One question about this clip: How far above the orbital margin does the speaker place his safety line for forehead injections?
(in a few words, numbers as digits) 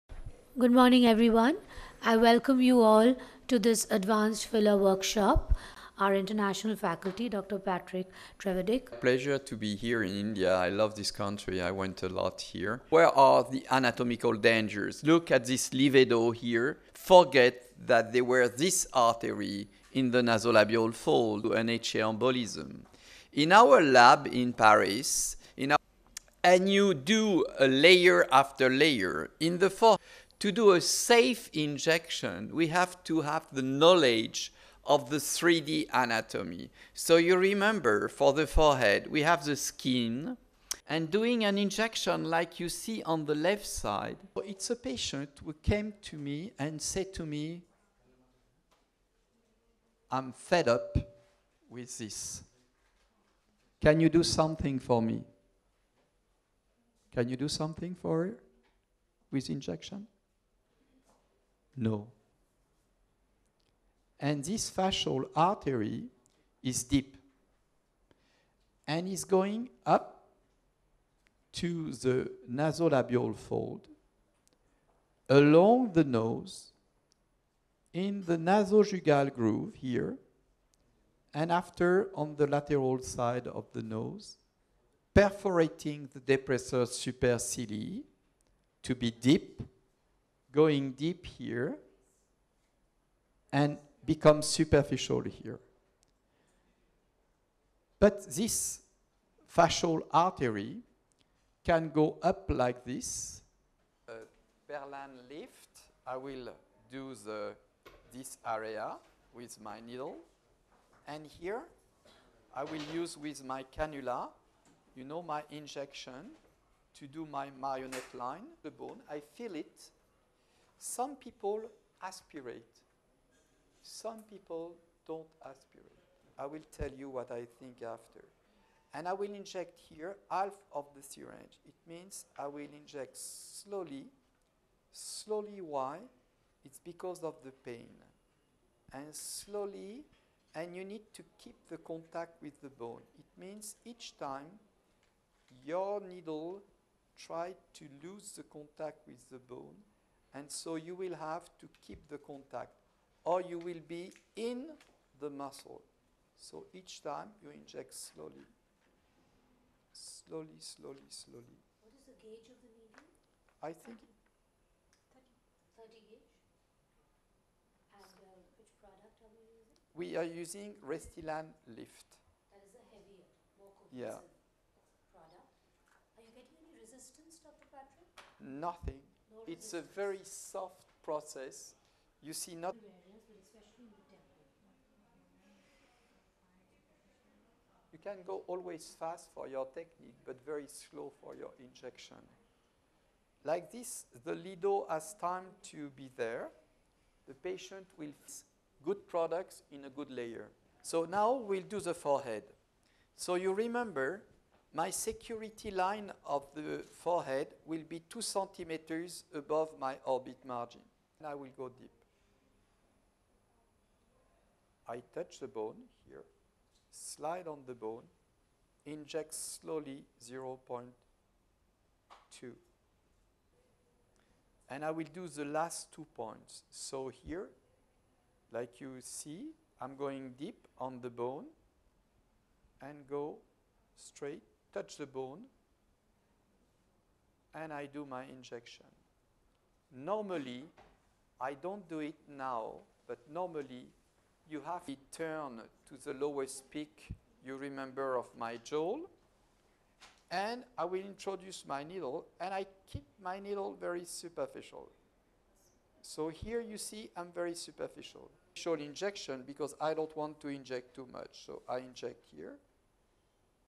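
2 centimeters.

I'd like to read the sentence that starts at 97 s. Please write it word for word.
But this facial artery can go up like this.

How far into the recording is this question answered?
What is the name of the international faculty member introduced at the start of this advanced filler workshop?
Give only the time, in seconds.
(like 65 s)
7 s.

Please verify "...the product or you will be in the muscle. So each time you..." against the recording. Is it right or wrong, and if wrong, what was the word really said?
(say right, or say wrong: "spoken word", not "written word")
wrong: "contact", not "product".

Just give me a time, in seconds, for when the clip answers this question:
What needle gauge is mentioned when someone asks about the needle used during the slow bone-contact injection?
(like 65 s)
165 s.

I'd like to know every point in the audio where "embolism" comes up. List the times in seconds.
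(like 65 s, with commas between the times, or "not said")
21 s.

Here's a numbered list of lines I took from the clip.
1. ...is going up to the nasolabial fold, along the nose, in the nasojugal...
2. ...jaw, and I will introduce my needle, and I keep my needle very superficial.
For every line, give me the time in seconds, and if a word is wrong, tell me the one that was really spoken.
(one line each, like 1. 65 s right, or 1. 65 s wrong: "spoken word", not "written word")
1. 69 s right
2. 248 s right.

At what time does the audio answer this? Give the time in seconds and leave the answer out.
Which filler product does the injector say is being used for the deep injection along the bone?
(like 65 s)
170 s.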